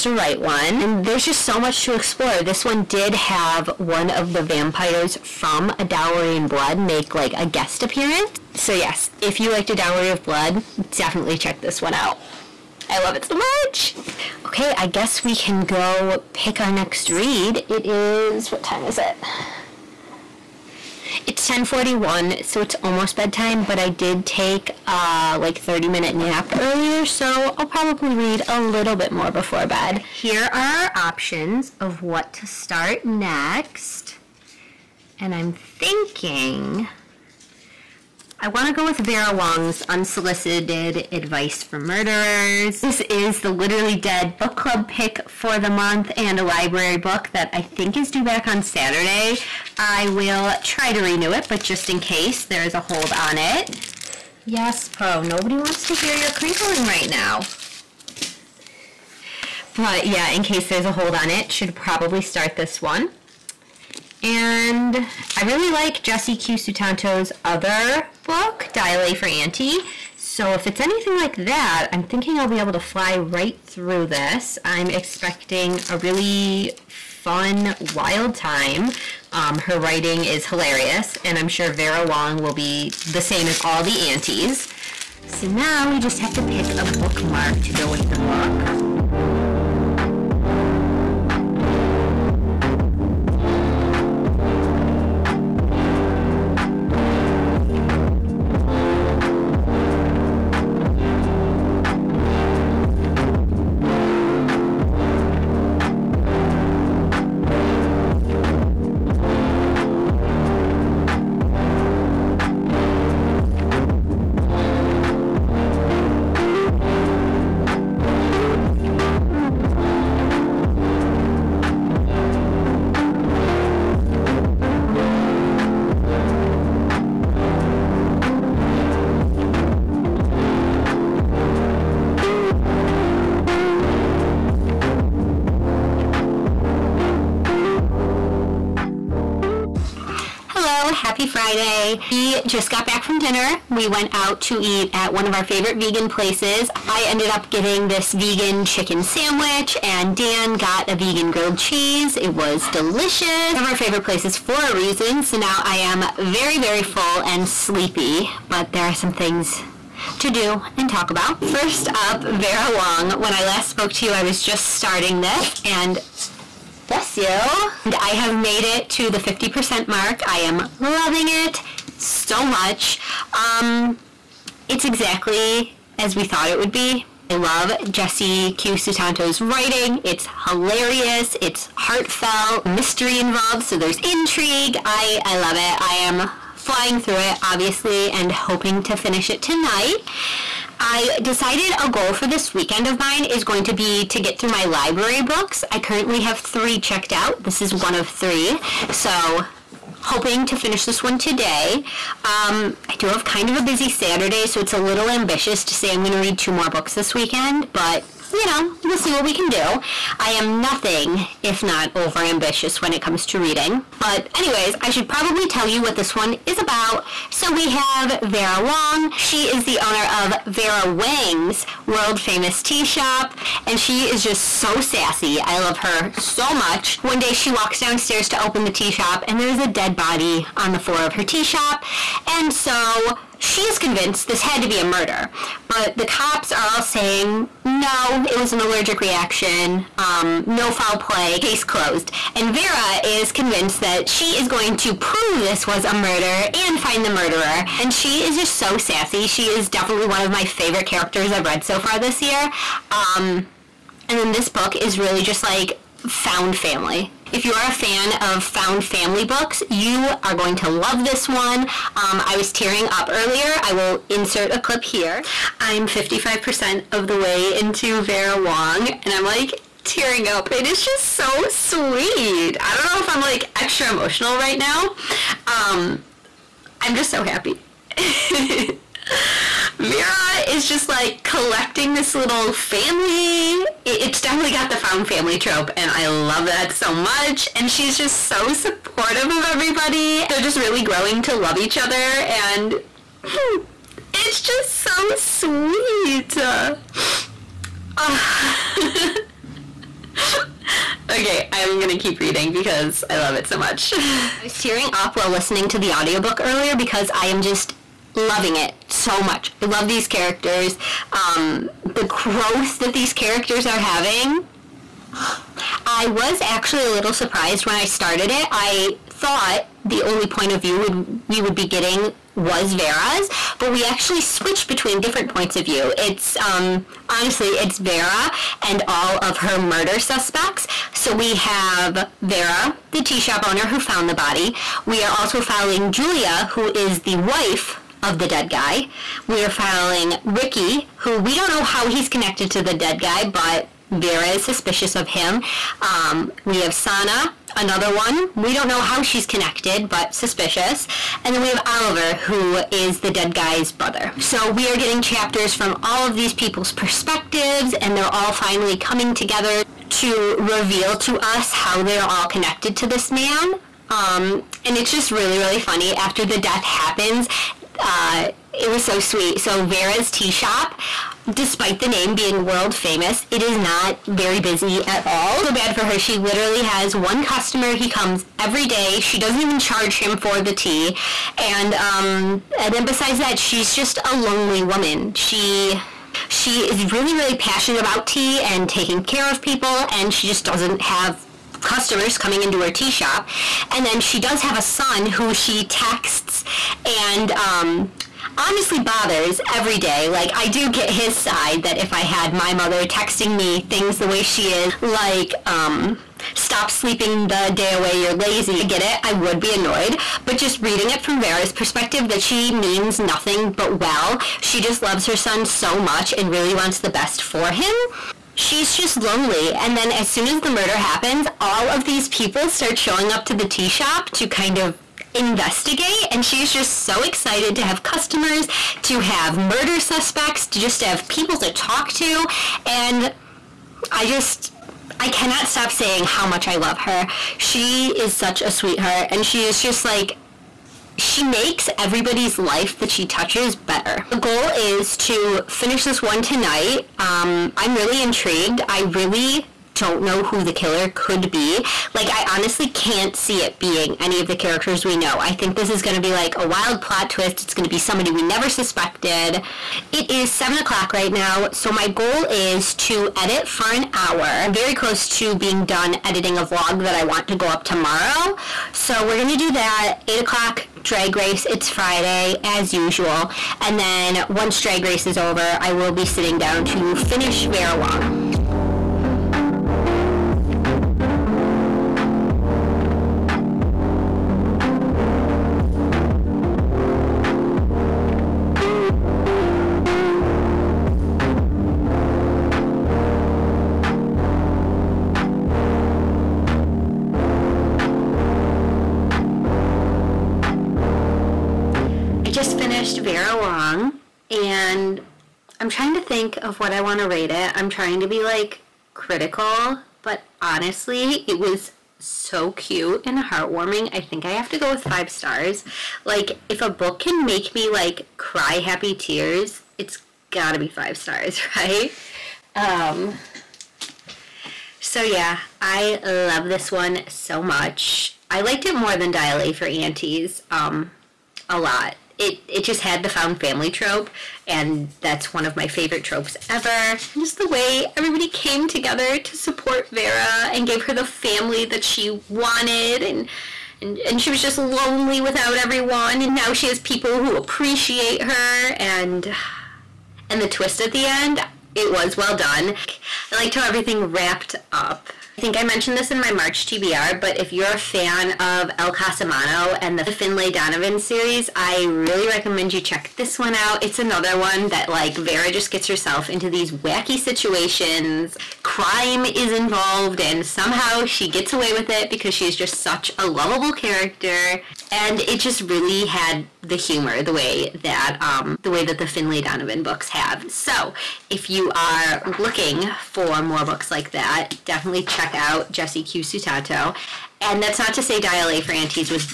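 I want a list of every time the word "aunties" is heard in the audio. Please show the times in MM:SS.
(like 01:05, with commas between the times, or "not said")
01:09, 01:24, 08:49, 09:48.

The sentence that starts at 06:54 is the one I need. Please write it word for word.
She just loves her son so much and really wants the best for him.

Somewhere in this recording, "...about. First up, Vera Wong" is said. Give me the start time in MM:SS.
02:41.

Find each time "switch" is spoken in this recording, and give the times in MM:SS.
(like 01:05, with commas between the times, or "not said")
05:24.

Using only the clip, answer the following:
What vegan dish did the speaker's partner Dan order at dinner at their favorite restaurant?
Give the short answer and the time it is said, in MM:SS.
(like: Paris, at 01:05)
vegan grilled cheese, at 02:30.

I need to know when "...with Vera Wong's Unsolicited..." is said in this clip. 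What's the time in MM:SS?
00:38.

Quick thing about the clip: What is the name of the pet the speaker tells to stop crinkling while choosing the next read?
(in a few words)
Poe.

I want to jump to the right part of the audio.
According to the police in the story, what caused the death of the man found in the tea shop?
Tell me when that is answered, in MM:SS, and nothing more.
03:58.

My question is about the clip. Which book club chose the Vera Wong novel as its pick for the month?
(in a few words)
Literally Dead.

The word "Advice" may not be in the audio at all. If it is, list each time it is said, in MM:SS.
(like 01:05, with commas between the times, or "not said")
00:41.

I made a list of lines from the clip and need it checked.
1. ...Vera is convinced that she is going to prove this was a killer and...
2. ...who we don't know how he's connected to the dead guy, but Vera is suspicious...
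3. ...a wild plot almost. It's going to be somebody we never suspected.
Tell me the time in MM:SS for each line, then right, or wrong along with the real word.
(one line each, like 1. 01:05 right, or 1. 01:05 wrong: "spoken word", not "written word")
1. 04:02 wrong: "murder", not "killer"
2. 05:40 right
3. 07:36 wrong: "twist", not "almost".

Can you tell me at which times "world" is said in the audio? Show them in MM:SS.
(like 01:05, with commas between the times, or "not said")
03:41, 06:12.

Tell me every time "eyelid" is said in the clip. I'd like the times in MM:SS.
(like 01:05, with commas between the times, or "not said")
not said.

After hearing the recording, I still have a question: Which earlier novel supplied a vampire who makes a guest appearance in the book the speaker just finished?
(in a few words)
A Dowry of Blood.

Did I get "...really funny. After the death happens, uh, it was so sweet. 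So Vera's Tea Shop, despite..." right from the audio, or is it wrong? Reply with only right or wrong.
right.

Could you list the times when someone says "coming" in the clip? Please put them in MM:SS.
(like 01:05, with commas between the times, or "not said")
05:58, 06:32.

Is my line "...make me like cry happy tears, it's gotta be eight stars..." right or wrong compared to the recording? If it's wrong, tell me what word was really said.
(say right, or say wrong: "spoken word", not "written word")
wrong: "five", not "eight".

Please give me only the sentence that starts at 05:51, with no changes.
And then we have Oliver, who is the dead guy's brother.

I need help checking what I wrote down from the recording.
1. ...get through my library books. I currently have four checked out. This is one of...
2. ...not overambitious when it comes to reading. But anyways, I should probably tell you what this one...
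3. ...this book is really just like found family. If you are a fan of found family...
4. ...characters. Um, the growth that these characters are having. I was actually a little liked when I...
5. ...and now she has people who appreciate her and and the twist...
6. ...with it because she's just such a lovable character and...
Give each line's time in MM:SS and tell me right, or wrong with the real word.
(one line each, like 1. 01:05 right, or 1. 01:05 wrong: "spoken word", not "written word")
1. 03:14 wrong: "three", not "four"
2. 03:31 right
3. 04:14 right
4. 05:10 wrong: "surprised", not "liked"
5. 09:06 right
6. 09:31 right.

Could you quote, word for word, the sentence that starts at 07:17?
She is such a sweetheart and she is just like she makes everybody's life that she touches better.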